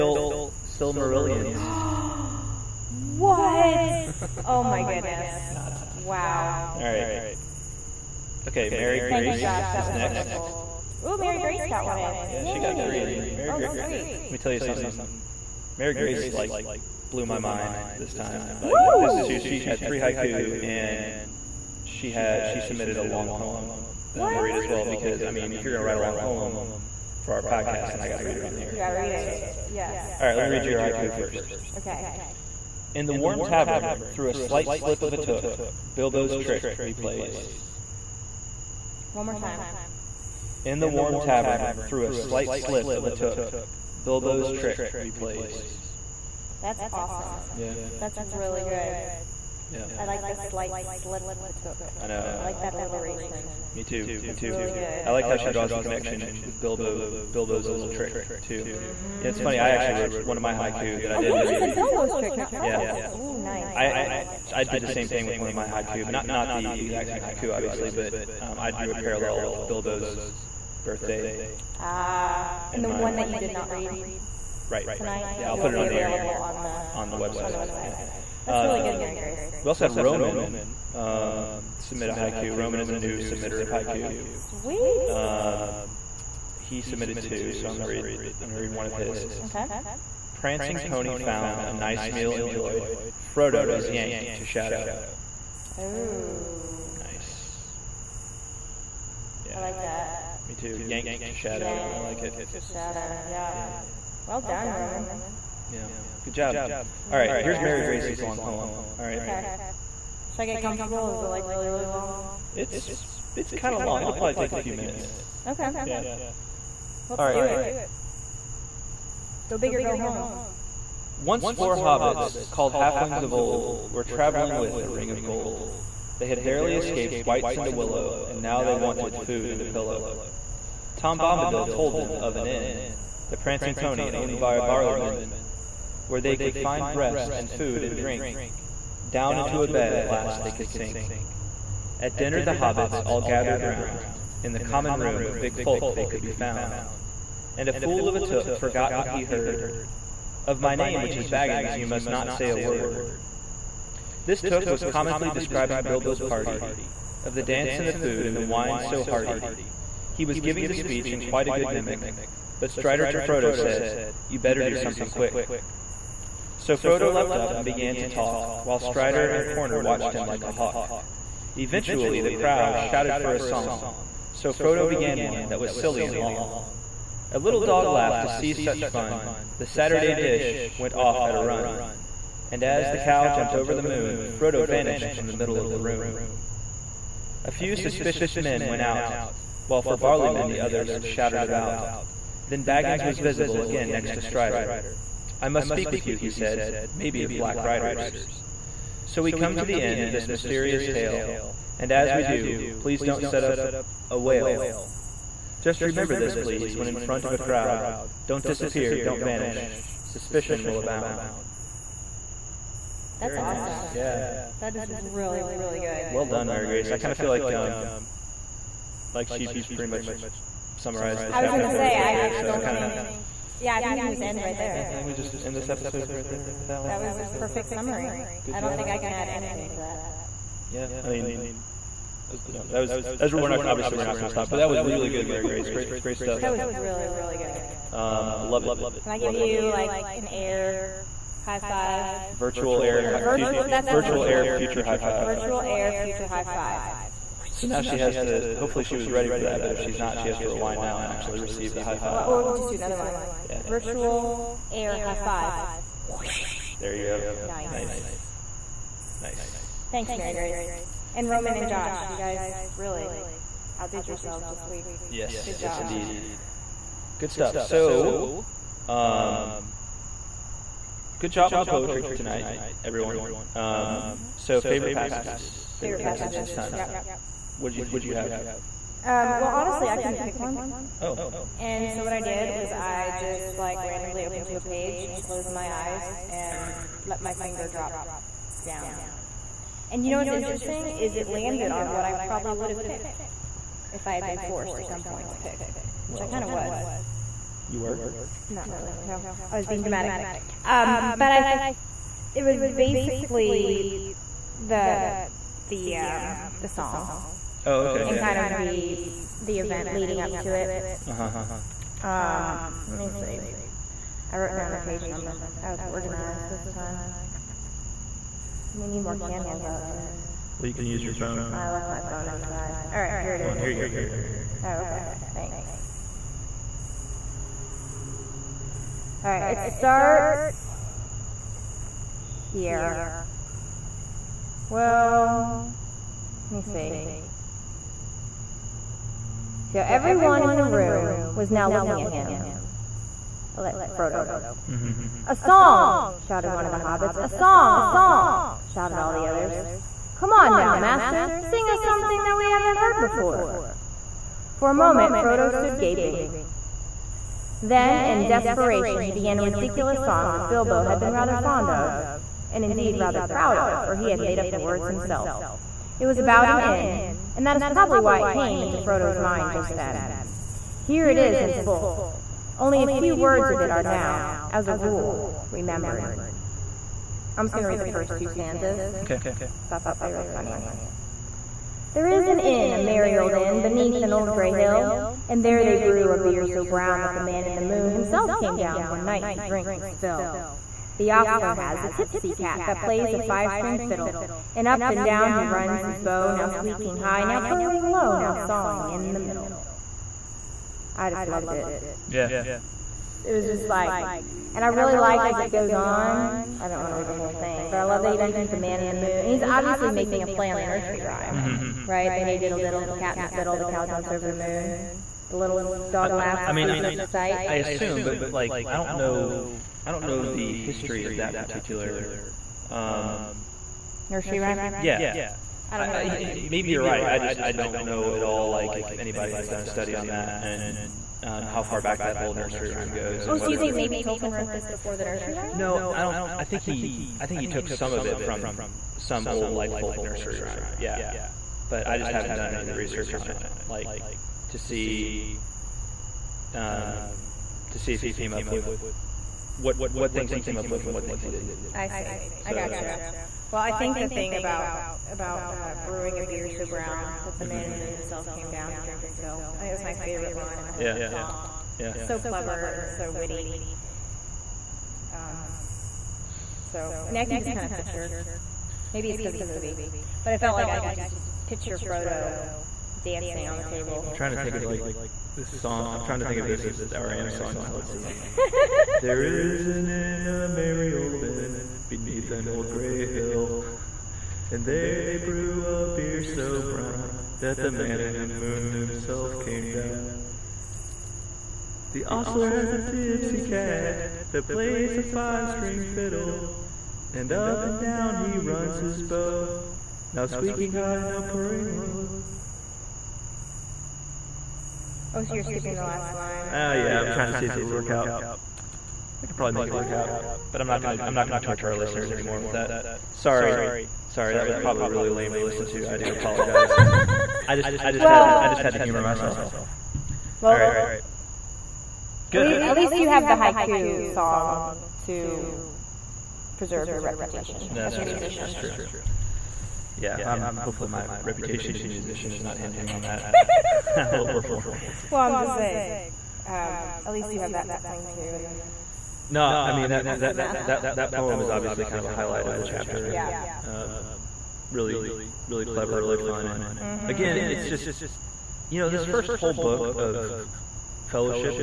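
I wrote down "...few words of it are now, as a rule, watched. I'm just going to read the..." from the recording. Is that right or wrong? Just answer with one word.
wrong.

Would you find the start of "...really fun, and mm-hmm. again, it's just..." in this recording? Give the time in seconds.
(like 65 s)
545 s.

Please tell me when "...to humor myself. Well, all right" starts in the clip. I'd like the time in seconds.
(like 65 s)
518 s.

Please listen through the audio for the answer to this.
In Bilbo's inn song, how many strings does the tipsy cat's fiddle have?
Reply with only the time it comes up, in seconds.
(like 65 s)
393 s.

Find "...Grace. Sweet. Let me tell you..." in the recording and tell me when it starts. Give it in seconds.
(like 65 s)
13 s.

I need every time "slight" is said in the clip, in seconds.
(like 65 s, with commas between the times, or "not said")
34 s, 42 s, 50 s.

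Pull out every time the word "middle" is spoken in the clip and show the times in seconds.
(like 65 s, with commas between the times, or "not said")
185 s, 399 s.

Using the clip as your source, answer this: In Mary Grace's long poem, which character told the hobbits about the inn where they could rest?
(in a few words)
Tom Bombadil.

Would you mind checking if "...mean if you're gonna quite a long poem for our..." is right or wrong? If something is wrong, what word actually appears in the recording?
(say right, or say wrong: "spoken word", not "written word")
wrong: "write", not "quite".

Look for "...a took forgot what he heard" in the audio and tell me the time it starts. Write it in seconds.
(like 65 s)
148 s.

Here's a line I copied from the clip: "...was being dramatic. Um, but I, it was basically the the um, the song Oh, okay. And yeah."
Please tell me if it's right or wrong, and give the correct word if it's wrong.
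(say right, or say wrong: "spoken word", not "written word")
right.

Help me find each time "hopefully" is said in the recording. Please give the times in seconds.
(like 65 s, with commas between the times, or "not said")
248 s, 530 s.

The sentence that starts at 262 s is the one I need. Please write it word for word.
You guys really outdid yourselves this week.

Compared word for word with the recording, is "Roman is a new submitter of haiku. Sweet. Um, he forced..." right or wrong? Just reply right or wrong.
wrong.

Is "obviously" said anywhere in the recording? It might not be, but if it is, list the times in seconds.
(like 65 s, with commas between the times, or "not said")
67 s, 233 s, 409 s, 541 s.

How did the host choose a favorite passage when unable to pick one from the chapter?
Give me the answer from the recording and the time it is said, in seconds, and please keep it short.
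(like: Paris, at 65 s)
randomly opened to a page, at 283 s.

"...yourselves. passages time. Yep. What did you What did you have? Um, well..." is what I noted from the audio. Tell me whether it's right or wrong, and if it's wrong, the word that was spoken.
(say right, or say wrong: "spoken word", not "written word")
wrong: "passages", not "yourselves".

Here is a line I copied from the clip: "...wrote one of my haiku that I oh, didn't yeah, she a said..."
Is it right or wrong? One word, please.
right.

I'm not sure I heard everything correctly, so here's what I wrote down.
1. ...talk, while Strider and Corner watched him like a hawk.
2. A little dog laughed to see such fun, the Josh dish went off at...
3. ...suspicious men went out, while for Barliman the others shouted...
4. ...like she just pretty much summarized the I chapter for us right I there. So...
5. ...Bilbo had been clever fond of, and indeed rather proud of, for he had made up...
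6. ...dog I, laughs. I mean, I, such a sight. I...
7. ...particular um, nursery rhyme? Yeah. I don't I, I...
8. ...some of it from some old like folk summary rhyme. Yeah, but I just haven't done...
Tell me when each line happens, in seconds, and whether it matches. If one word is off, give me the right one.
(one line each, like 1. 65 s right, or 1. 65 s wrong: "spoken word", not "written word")
1. 168 s right
2. 177 s wrong: "Saturday", not "Josh"
3. 187 s right
4. 219 s right
5. 360 s wrong: "rather", not "clever"
6. 415 s right
7. 421 s right
8. 437 s wrong: "nursery", not "summary".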